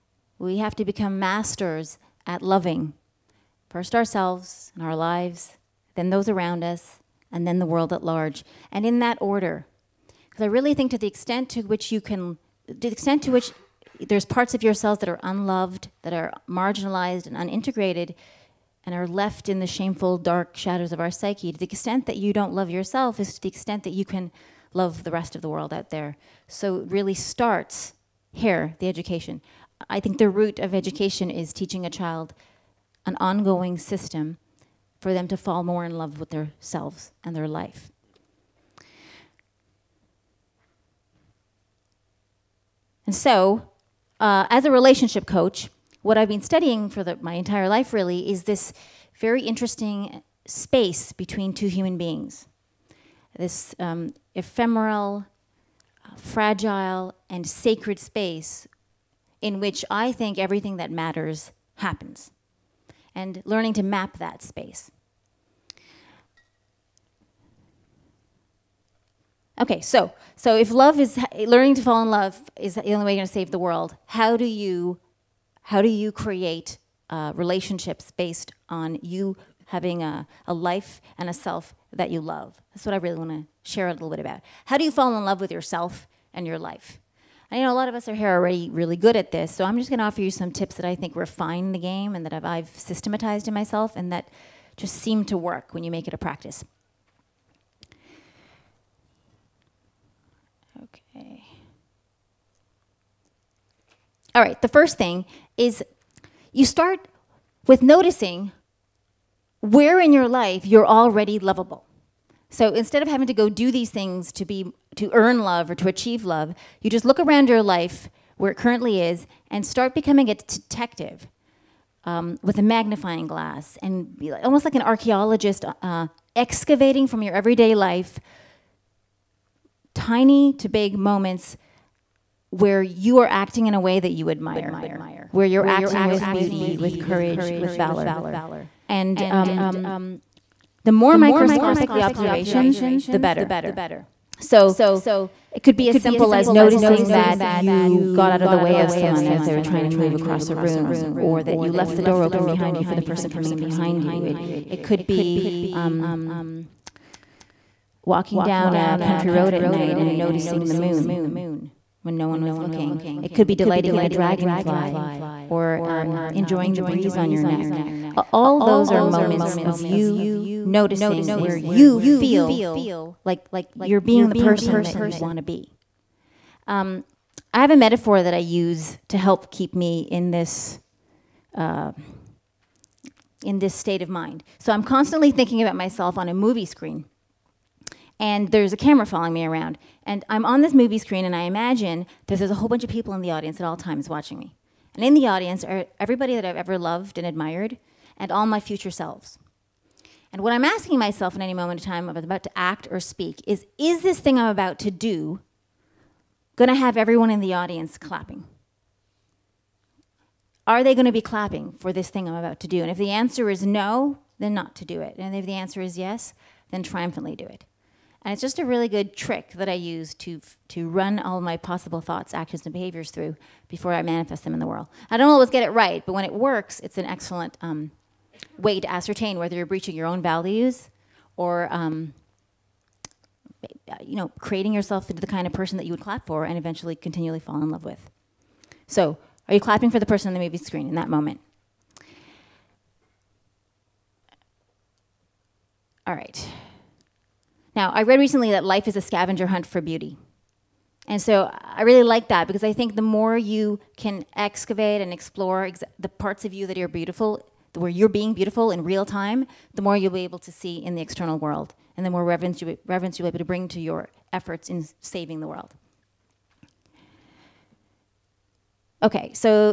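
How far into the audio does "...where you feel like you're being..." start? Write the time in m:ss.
2:51.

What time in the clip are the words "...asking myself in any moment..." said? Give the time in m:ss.
3:20.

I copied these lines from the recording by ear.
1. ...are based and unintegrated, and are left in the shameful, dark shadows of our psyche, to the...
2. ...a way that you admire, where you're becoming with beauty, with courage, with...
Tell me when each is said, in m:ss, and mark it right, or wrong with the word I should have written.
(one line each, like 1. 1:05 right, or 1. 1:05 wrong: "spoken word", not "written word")
1. 0:16 wrong: "marginalized", not "based"
2. 2:13 wrong: "acting", not "becoming".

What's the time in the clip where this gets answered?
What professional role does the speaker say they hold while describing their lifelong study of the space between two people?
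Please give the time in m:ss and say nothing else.
0:44.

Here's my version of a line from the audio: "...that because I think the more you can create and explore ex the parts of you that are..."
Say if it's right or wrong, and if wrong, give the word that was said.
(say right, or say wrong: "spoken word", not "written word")
wrong: "excavate", not "create".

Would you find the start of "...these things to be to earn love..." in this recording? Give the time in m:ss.
1:53.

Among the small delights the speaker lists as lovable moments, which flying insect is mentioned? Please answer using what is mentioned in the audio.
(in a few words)
dragonfly.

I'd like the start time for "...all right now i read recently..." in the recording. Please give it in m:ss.
4:06.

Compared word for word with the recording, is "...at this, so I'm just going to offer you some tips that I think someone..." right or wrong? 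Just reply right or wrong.
wrong.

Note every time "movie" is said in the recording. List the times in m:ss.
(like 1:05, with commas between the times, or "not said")
3:06, 3:10, 4:00.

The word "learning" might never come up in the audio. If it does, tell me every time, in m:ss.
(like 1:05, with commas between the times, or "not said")
1:03, 1:11.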